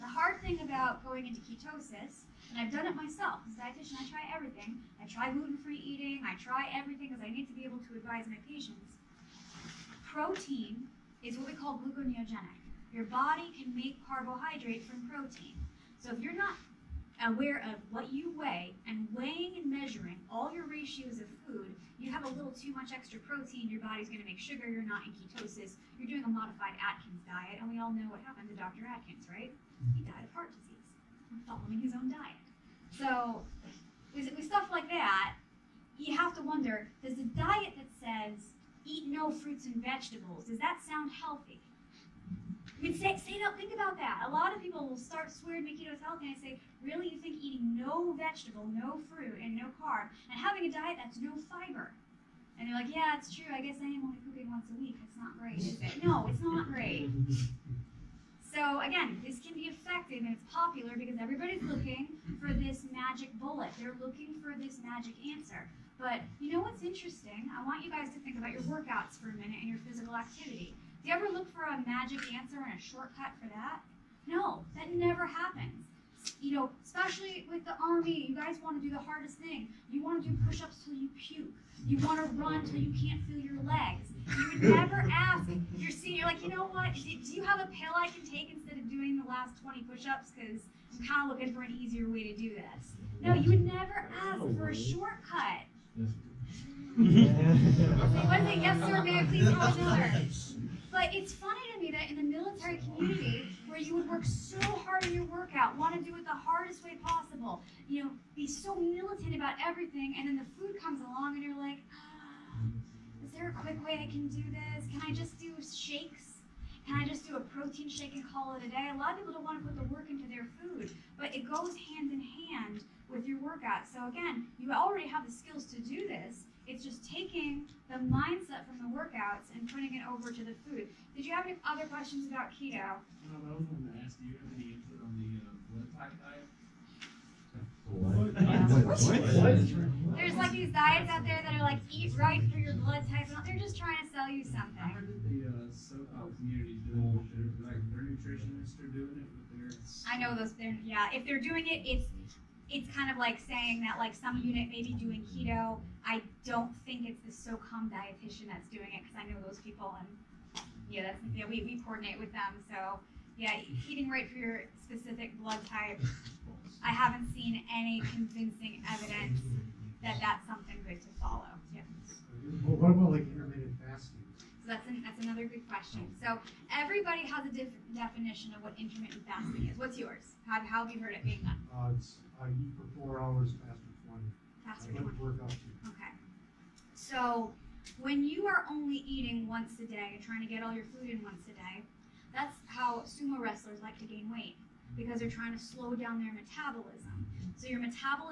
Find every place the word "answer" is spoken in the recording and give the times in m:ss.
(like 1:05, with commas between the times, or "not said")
1:05, 1:12.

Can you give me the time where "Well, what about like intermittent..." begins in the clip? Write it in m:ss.
2:52.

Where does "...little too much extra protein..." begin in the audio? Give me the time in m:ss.
0:22.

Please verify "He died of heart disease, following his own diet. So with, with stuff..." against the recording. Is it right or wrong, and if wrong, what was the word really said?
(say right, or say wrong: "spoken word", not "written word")
right.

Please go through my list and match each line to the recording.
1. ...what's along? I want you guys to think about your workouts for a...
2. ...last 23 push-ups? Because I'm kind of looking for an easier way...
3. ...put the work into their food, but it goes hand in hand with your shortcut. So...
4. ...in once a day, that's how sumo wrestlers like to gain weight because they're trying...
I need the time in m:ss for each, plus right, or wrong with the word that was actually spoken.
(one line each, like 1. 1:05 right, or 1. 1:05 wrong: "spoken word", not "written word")
1. 1:06 wrong: "interesting", not "along"
2. 1:29 wrong: "20", not "23"
3. 1:59 wrong: "workout", not "shortcut"
4. 3:11 right.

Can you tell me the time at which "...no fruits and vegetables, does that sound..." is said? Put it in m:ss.
0:39.